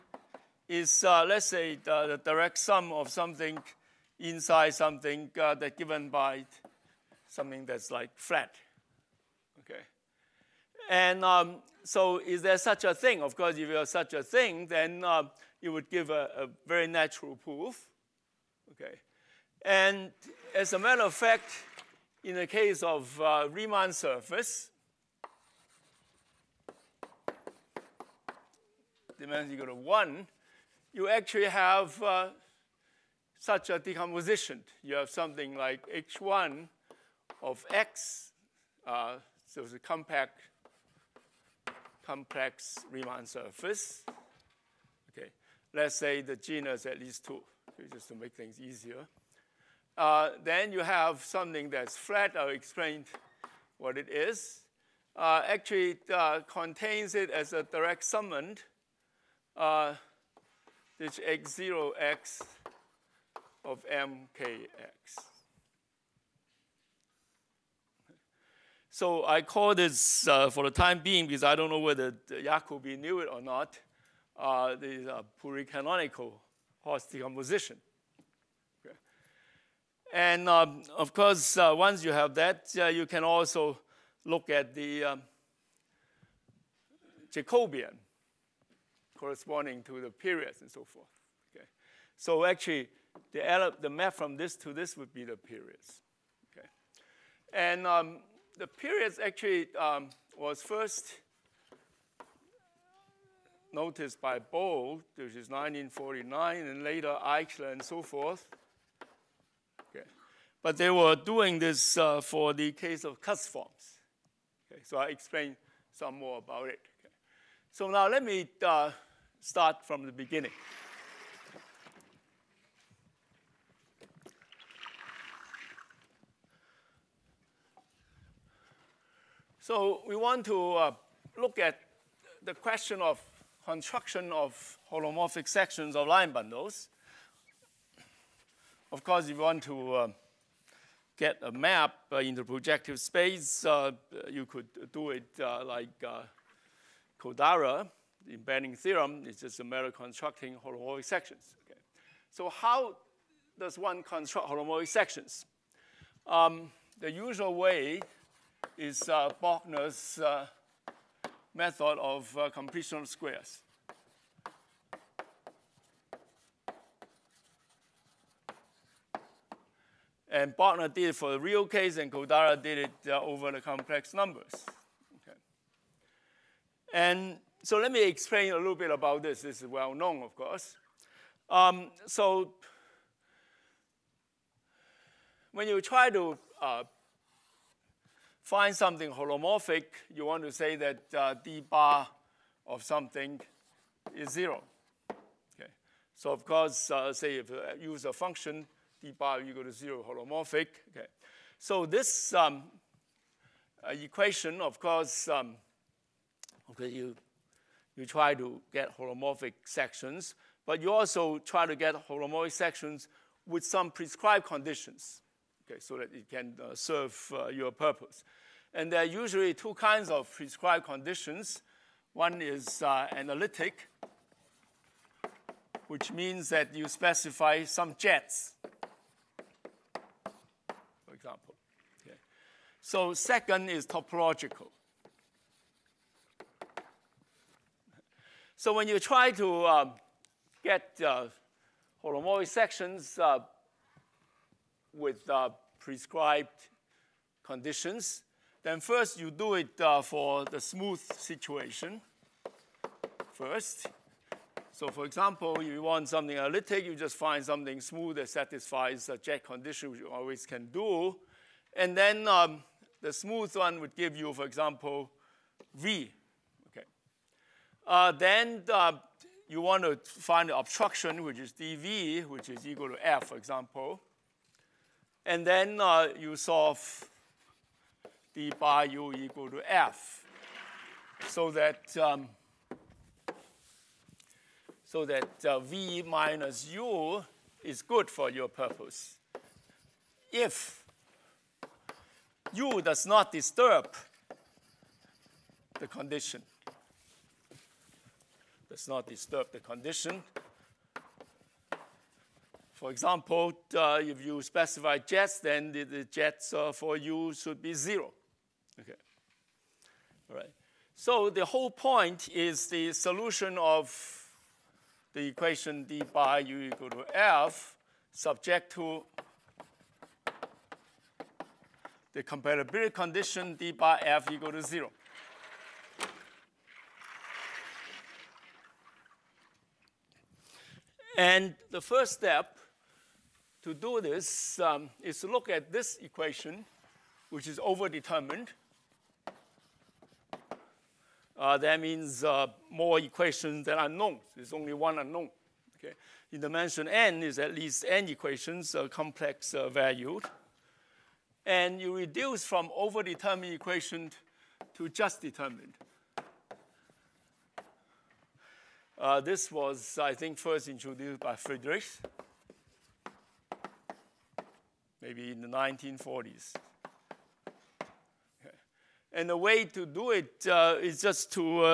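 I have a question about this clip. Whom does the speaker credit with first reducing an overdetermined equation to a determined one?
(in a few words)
Friedrich.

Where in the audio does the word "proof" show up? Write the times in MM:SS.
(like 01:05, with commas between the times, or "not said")
00:17.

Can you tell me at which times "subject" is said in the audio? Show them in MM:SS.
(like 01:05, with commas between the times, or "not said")
05:18.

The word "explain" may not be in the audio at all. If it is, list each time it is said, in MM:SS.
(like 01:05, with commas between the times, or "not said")
00:52, 01:55, 02:58.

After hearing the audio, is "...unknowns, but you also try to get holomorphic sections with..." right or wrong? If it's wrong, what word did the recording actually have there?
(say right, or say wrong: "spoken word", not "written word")
wrong: "sections", not "unknowns".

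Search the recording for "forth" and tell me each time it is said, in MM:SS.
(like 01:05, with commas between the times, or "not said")
01:30, 01:48.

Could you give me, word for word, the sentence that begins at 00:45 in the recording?
Okay, let's say the genus at least 2 just to make things easier.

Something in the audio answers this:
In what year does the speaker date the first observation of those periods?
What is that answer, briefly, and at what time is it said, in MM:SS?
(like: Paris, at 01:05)
1949, at 01:45.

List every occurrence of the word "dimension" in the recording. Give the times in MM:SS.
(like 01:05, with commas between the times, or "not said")
00:29, 05:46.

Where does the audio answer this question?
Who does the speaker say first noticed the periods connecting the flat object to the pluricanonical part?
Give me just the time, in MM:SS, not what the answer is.
01:44.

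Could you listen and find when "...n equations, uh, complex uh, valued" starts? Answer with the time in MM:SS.
05:47.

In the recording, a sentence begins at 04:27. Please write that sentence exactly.
Uh, then uh, you want to find the obstruction, which is dV, which is equal to F, for example.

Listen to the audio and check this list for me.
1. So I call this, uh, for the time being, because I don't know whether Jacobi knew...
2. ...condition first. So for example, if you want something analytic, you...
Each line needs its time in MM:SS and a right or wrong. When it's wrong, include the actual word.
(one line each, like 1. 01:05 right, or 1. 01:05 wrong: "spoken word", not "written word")
1. 01:08 right
2. 04:11 wrong: "situation", not "condition".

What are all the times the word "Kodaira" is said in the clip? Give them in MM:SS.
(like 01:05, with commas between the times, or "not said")
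02:27, 02:52.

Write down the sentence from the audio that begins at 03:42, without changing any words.
One is uh, analytic, which means that you specify some jets, for example.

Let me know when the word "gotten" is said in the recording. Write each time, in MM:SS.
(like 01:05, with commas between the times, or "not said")
not said.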